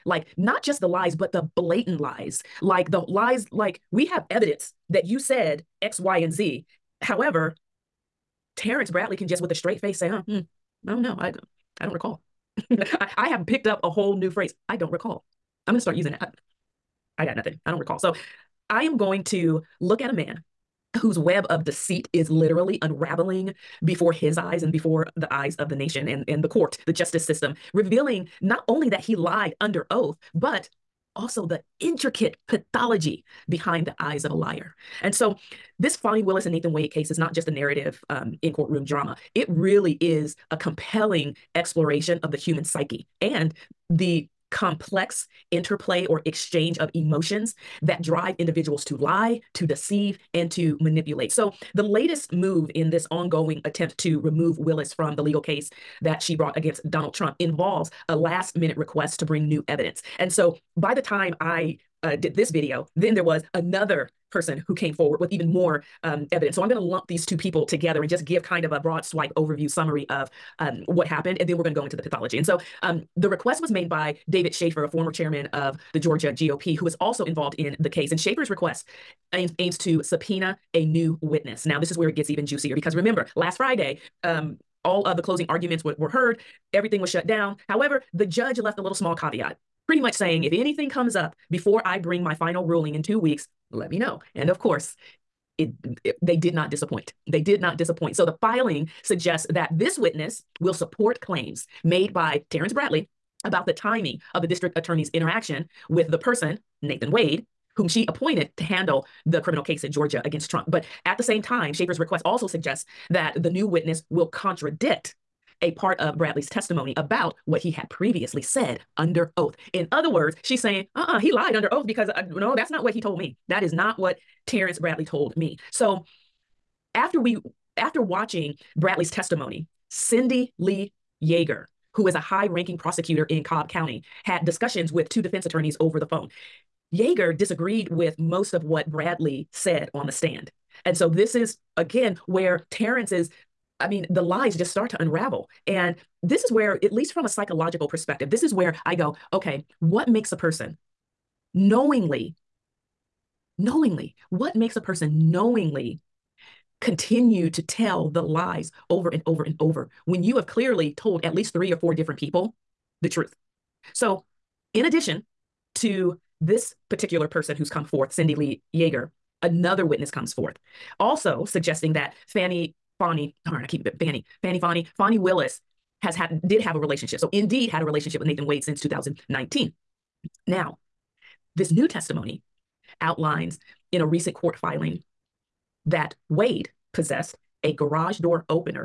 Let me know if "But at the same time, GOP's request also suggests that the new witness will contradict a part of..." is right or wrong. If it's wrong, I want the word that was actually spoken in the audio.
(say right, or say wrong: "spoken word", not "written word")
wrong: "Shafer", not "GOP".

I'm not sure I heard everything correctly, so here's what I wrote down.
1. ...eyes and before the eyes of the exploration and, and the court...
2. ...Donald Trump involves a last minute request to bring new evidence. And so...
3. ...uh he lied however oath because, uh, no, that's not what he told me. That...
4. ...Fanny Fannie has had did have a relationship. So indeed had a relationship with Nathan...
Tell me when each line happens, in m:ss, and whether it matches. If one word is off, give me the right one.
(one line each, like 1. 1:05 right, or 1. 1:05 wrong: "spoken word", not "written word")
1. 0:24 wrong: "nation", not "exploration"
2. 0:56 right
3. 2:01 wrong: "under", not "however"
4. 2:54 wrong: "Willis", not "Fannie".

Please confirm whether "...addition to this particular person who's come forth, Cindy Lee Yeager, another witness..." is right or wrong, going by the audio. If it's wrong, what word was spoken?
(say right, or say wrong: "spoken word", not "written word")
right.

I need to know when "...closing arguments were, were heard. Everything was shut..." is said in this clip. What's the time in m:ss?
1:25.